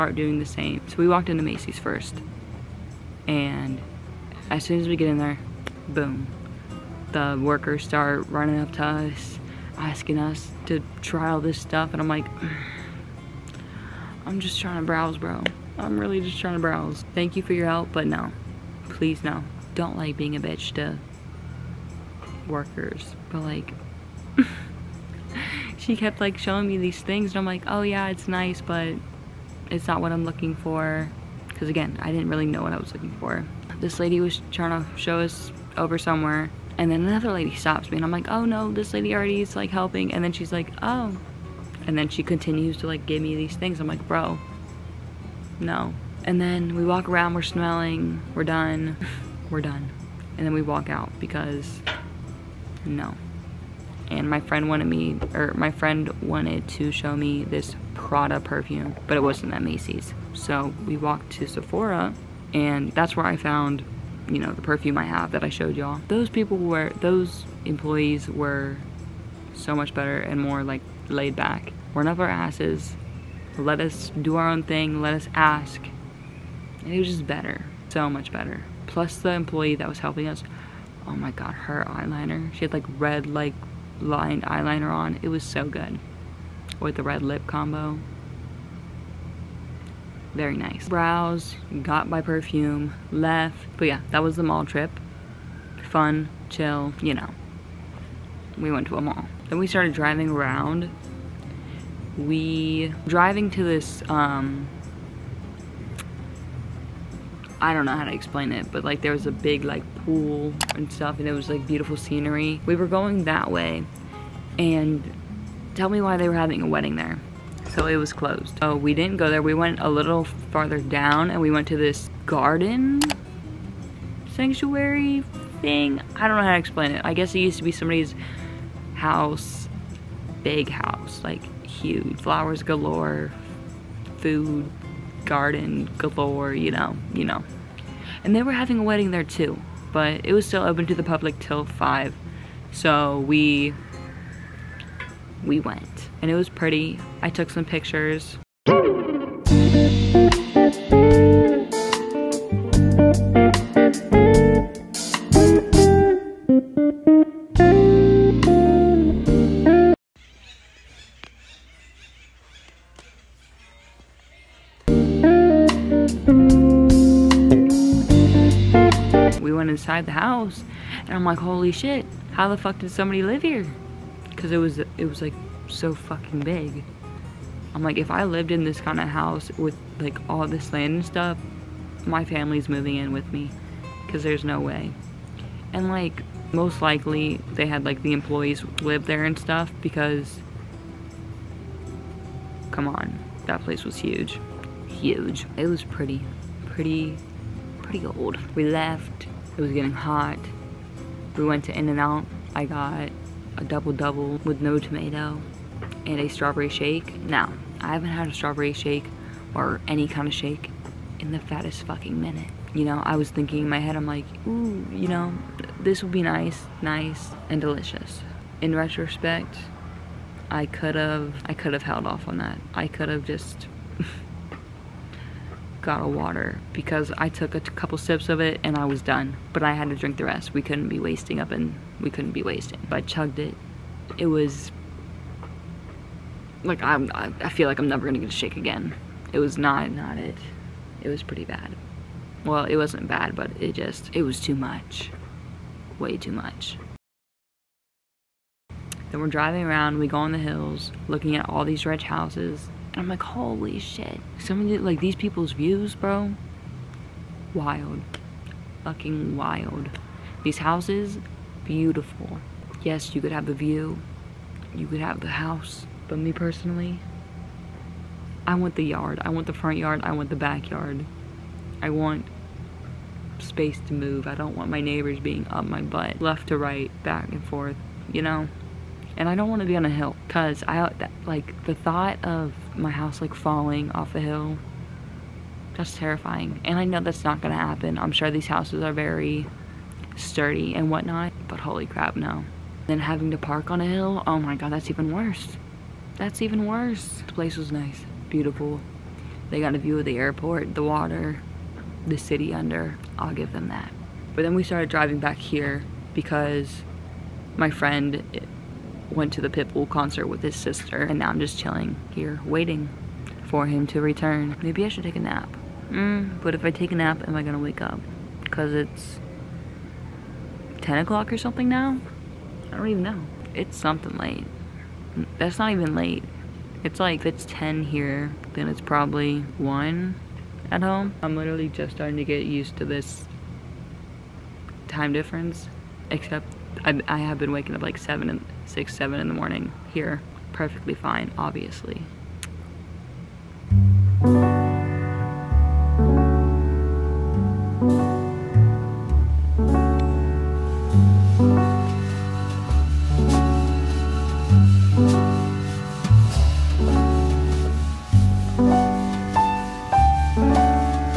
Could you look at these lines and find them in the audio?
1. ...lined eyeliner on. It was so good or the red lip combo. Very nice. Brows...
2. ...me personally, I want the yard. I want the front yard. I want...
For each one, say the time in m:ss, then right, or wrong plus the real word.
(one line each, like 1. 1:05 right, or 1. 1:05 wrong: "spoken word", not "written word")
1. 1:23 right
2. 4:26 right.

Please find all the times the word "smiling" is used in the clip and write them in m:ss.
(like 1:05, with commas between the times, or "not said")
not said.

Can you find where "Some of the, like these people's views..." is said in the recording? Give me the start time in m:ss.
4:14.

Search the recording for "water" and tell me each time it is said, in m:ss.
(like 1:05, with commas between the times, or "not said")
3:46, 5:00.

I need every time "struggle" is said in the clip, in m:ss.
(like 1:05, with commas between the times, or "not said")
not said.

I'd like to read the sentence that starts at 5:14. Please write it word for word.
Maybe I should take a nap.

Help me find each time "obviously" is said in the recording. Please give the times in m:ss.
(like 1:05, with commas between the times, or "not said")
5:41.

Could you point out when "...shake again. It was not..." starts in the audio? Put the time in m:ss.
3:58.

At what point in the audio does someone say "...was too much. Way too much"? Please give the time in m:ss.
4:04.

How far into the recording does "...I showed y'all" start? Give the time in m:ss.
1:05.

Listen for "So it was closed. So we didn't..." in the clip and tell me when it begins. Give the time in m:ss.
1:57.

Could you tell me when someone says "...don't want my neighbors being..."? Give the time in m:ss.
4:34.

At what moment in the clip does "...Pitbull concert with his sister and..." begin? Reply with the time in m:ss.
5:09.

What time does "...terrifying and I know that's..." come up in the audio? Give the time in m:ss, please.
4:45.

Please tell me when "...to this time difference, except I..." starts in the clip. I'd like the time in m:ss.
5:32.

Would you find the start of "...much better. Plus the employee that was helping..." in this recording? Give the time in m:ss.
1:18.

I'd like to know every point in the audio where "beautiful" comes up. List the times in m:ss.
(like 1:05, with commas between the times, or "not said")
1:51, 4:21, 4:58.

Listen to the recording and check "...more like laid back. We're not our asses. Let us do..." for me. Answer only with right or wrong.
right.